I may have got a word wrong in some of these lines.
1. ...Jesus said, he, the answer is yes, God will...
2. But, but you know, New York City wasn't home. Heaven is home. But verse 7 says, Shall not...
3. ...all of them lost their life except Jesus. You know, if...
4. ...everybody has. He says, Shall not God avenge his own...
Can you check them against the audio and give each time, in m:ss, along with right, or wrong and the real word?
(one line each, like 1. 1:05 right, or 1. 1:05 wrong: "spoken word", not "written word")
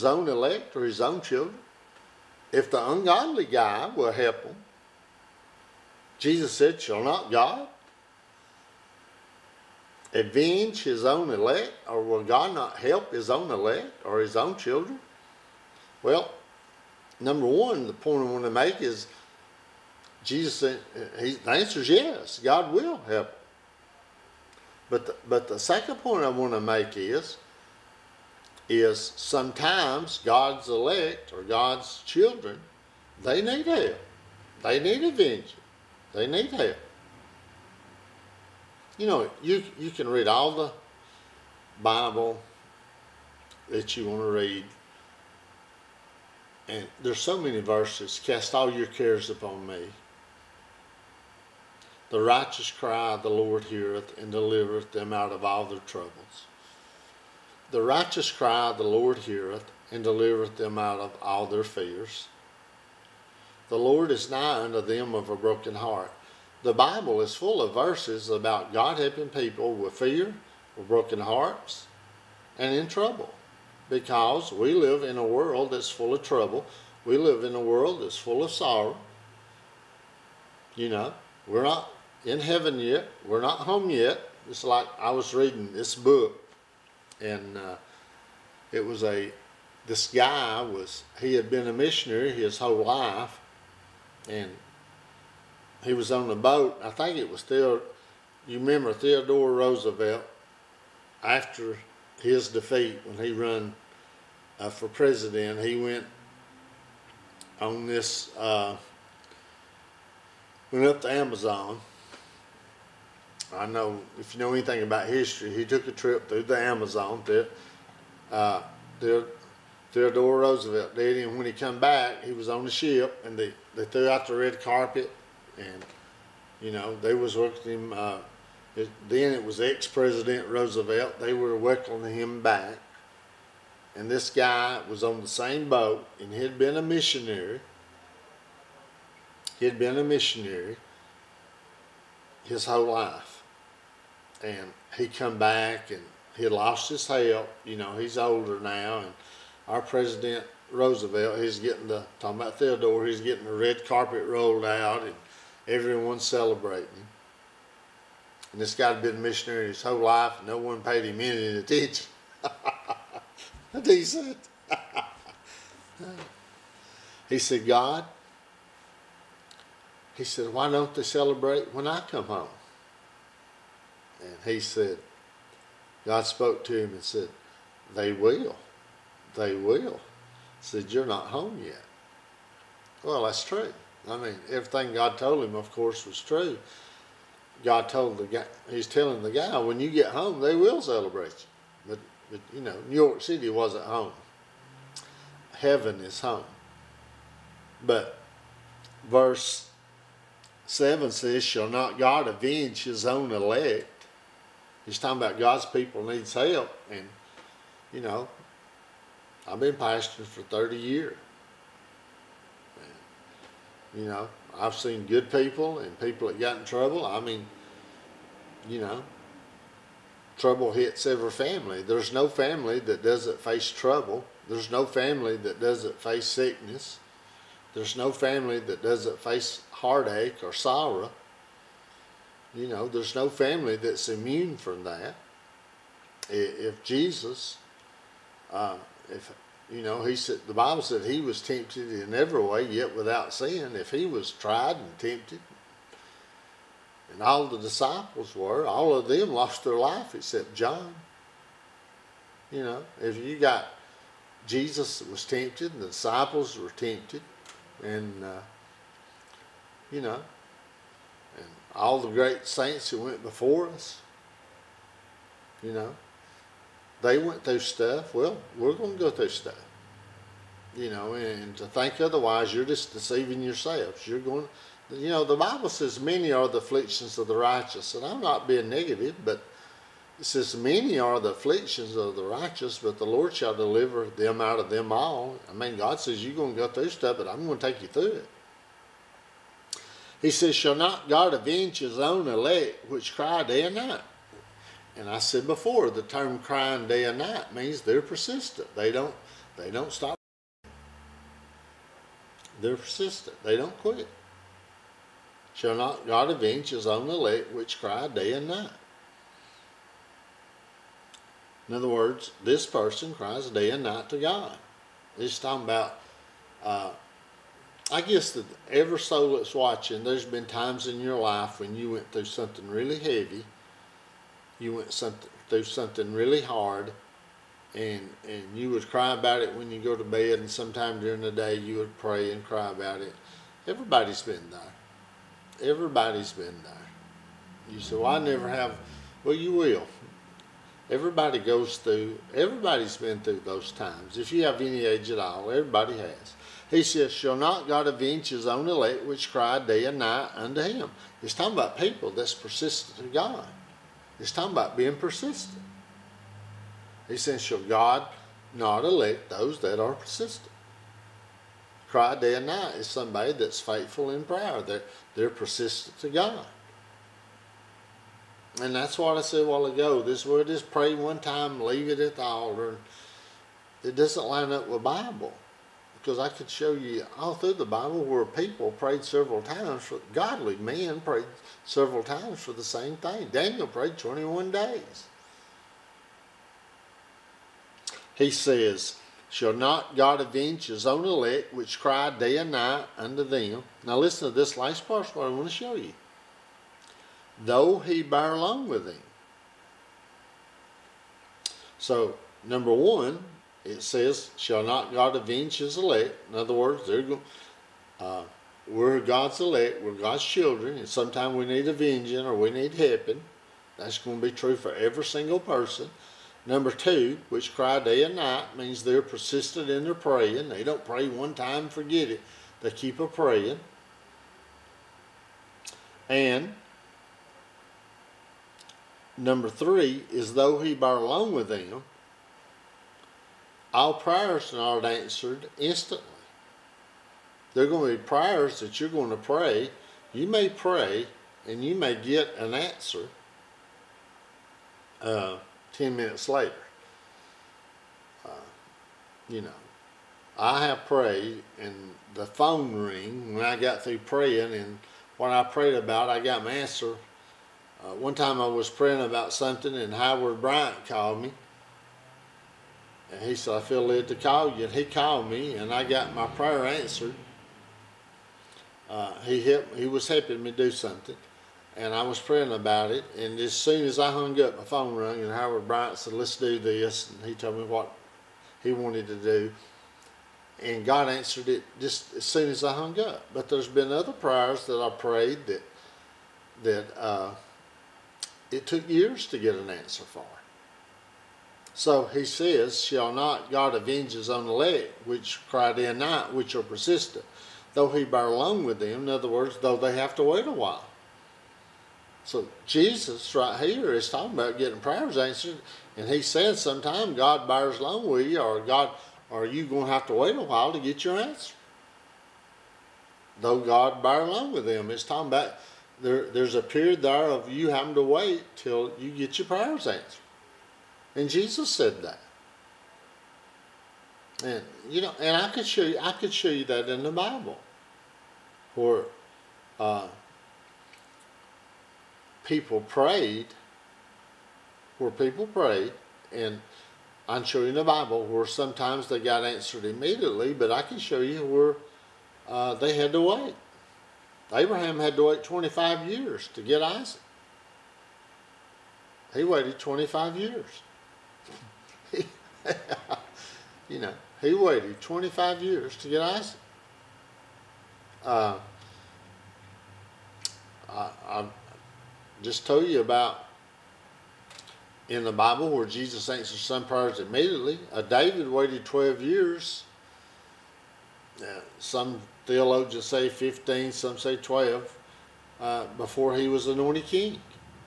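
1. 0:20 right
2. 3:11 right
3. 4:08 wrong: "John", not "Jesus"
4. 5:45 right.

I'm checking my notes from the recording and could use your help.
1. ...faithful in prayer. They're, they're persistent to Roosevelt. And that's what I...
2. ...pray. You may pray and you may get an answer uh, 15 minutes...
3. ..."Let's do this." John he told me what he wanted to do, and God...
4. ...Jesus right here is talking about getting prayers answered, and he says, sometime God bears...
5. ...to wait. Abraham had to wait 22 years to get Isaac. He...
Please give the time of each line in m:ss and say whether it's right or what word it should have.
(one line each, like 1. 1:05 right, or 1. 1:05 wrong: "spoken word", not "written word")
1. 6:03 wrong: "God", not "Roosevelt"
2. 7:19 wrong: "10", not "15"
3. 7:56 wrong: "And", not "John"
4. 8:22 right
5. 9:03 wrong: "25", not "22".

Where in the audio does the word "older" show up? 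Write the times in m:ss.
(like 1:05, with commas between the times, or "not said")
2:28.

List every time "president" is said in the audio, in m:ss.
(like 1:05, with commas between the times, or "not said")
1:44, 2:09, 2:29.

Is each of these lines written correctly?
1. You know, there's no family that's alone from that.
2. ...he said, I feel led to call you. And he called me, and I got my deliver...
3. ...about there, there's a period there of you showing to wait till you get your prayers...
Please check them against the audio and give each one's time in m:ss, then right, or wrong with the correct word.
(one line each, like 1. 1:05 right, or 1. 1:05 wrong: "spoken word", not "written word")
1. 3:52 wrong: "immune", not "alone"
2. 7:43 wrong: "prayer", not "deliver"
3. 8:35 wrong: "having", not "showing".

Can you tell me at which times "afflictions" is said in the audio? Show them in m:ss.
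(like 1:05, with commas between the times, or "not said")
4:36, 4:41.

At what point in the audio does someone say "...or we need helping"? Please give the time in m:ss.
6:52.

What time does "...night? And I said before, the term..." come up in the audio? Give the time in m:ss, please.
4:53.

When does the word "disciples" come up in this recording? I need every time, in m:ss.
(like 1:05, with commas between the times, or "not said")
4:07, 4:15.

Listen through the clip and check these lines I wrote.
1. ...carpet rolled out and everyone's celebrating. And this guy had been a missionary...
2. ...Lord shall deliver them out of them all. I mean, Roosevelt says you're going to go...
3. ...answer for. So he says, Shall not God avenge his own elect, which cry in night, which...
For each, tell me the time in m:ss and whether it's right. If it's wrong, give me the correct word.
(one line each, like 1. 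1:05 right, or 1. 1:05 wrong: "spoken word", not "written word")
1. 2:33 right
2. 4:43 wrong: "God", not "Roosevelt"
3. 8:09 right.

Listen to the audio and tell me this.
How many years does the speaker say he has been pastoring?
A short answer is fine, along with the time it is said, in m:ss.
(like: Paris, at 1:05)
30, at 3:30.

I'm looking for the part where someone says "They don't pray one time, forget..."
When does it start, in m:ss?
7:00.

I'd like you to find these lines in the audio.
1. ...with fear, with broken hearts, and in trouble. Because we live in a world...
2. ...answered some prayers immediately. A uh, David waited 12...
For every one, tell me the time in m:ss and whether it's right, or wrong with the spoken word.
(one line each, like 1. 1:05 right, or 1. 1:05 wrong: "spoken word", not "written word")
1. 1:09 right
2. 9:26 right.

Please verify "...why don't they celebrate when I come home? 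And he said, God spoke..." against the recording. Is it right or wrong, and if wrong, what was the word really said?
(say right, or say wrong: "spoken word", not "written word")
right.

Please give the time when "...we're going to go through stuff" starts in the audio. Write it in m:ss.
4:28.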